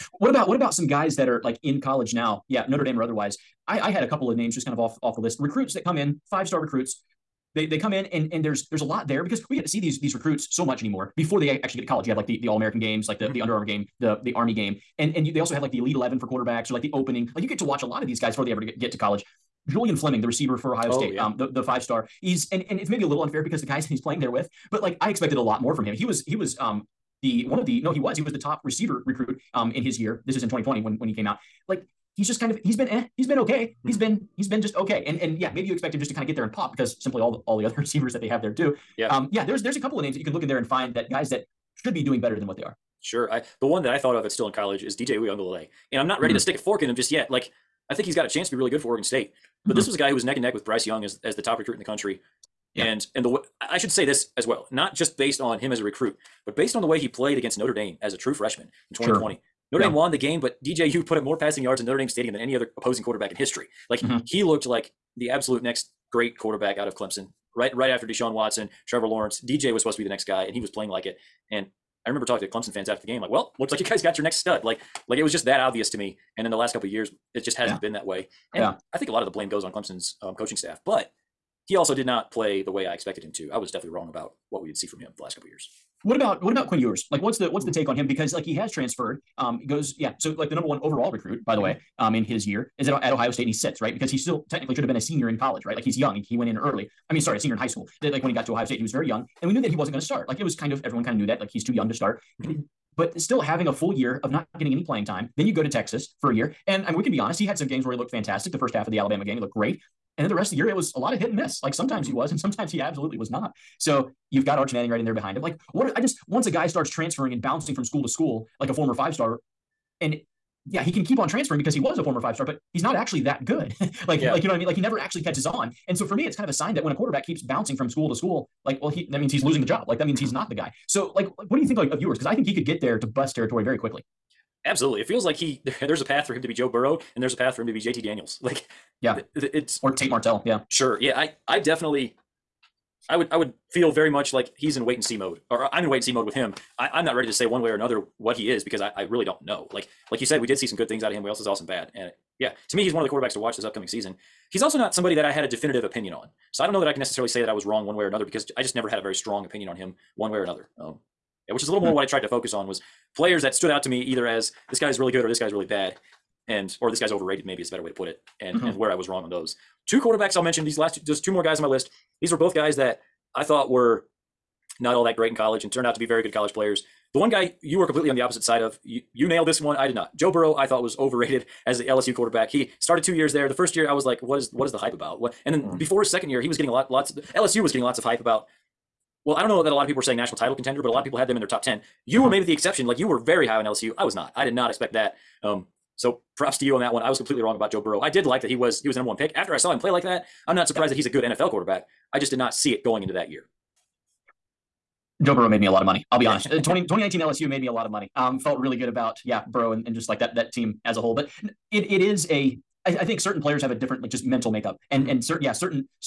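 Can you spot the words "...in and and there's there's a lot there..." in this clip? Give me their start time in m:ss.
0:07.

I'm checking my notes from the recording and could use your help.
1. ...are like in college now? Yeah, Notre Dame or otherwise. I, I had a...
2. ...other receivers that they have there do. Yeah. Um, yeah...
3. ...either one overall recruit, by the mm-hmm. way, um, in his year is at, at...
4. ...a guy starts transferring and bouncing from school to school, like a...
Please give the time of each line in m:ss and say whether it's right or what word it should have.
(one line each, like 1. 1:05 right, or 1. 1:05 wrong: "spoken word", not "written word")
1. 0:01 right
2. 0:37 right
3. 1:30 wrong: "number", not "either"
4. 1:56 right.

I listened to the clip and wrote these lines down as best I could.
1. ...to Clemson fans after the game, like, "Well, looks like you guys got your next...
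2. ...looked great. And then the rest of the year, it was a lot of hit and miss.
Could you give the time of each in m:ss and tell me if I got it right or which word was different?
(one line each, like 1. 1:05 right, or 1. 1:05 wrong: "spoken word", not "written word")
1. 1:12 right
2. 1:49 right.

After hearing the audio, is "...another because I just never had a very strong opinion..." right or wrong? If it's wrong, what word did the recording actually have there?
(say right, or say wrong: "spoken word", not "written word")
right.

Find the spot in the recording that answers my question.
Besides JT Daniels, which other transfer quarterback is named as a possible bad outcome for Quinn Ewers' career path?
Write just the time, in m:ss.
2:19.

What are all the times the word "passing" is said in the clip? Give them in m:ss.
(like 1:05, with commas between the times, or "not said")
1:01.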